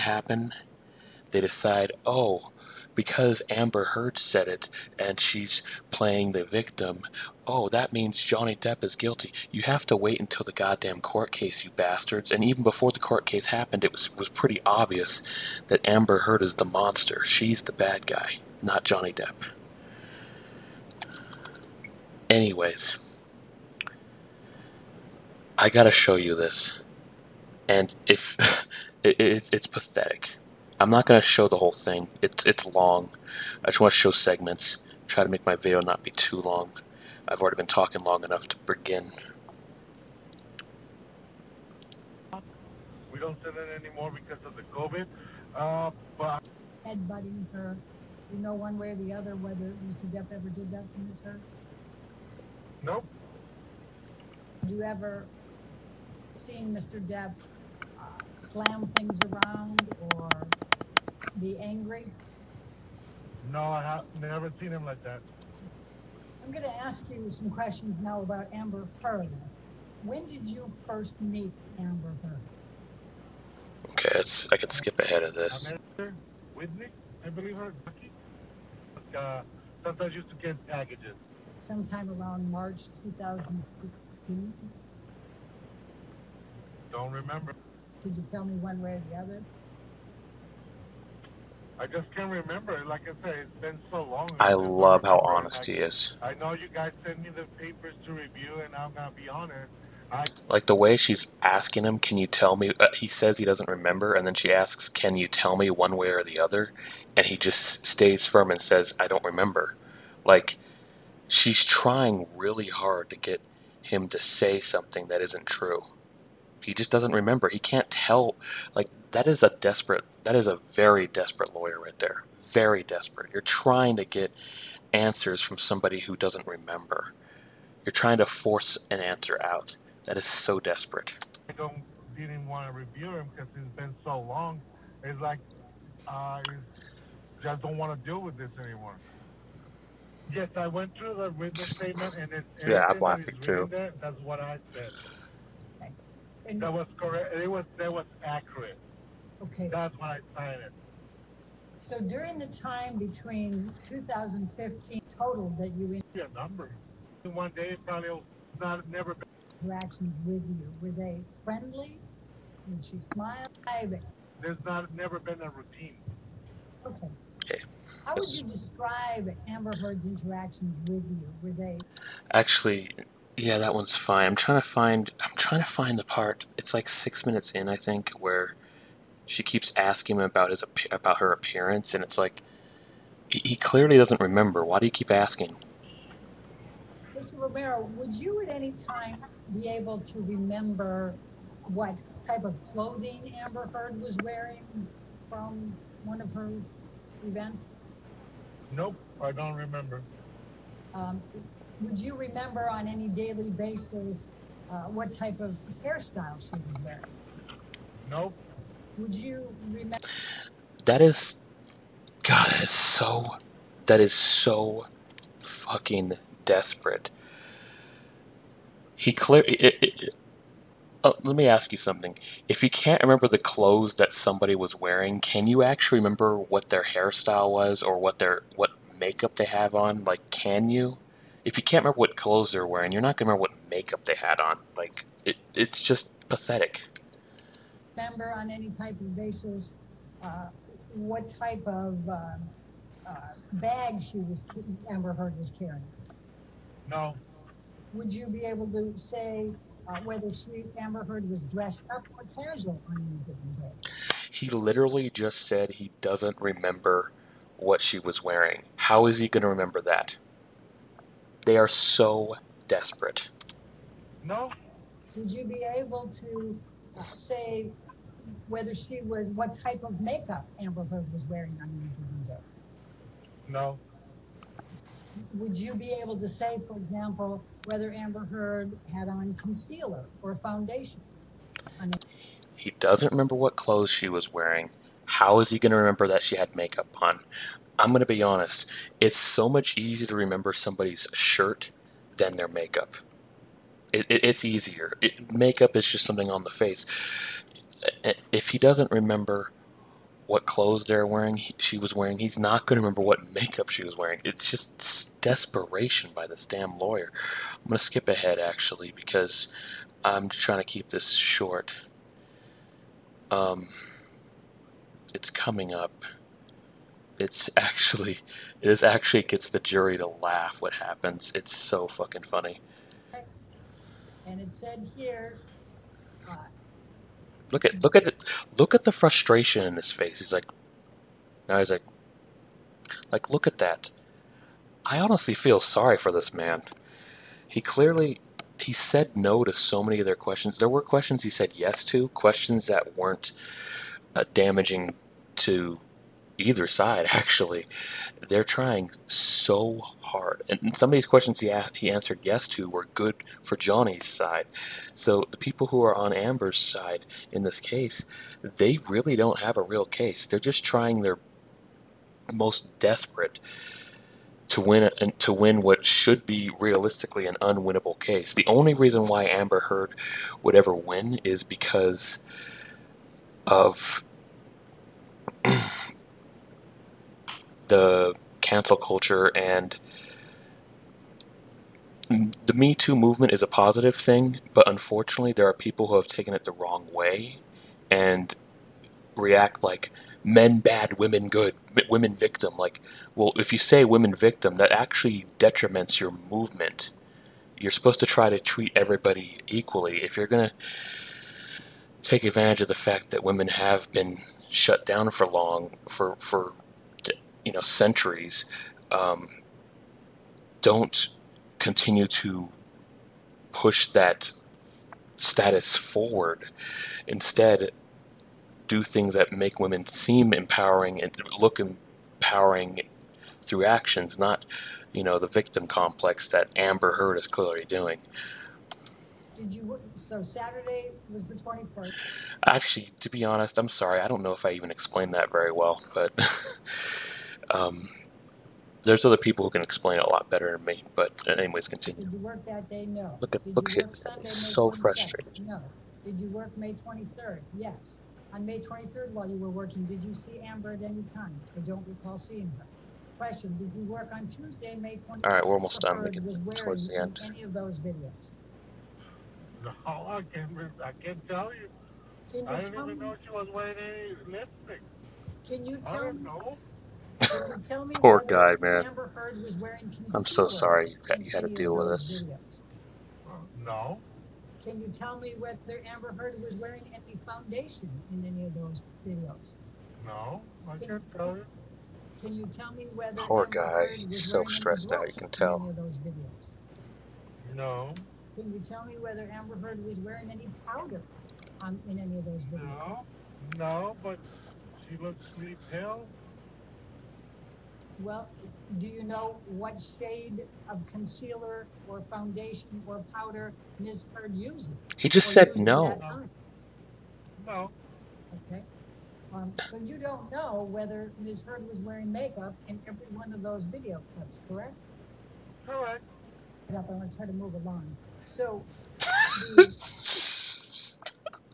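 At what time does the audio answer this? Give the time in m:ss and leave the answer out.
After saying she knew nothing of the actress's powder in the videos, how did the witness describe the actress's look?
8:15.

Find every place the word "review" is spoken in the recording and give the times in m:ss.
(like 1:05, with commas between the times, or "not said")
1:38, 2:12.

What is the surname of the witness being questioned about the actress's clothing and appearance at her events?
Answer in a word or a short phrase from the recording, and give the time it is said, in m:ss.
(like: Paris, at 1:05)
Romero, at 3:07.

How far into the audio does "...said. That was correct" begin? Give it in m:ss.
2:24.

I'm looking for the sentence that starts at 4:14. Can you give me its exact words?
He literally just said he doesn't remember what she was wearing.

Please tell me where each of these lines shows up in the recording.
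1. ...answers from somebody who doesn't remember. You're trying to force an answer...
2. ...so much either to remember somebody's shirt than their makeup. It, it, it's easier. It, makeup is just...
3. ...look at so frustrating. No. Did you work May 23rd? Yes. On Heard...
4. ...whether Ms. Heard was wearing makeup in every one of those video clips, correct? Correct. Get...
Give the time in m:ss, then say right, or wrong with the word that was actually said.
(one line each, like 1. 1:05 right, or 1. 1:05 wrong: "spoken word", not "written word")
1. 2:04 right
2. 4:49 wrong: "easier", not "either"
3. 7:23 wrong: "May", not "Heard"
4. 8:30 right.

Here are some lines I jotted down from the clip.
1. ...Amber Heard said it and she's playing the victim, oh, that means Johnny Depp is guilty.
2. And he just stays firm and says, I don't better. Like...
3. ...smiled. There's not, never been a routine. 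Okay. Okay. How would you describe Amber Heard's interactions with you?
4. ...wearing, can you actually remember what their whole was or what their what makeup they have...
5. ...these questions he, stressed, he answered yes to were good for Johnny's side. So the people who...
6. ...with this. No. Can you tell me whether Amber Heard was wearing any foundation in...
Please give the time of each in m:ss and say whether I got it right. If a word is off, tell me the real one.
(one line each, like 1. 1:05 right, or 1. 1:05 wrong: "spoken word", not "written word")
1. 0:03 right
2. 1:47 wrong: "remember", not "better"
3. 2:42 right
4. 3:44 wrong: "hairstyle", not "whole"
5. 5:50 wrong: "asked", not "stressed"
6. 7:51 right.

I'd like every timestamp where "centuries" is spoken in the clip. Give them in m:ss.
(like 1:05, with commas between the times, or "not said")
6:47.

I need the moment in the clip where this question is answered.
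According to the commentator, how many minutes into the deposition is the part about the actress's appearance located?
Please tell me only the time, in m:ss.
2:56.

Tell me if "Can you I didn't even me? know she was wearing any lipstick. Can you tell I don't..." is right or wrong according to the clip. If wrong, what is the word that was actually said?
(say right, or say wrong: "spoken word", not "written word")
right.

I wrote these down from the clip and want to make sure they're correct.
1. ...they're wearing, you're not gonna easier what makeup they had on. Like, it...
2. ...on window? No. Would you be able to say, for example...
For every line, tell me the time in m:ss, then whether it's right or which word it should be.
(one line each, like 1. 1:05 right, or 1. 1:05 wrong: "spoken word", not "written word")
1. 3:52 wrong: "remember", not "easier"
2. 4:31 right.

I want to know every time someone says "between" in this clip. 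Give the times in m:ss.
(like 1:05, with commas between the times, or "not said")
2:32.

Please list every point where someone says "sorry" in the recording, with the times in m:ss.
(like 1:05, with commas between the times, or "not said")
5:35, 7:13, 7:50.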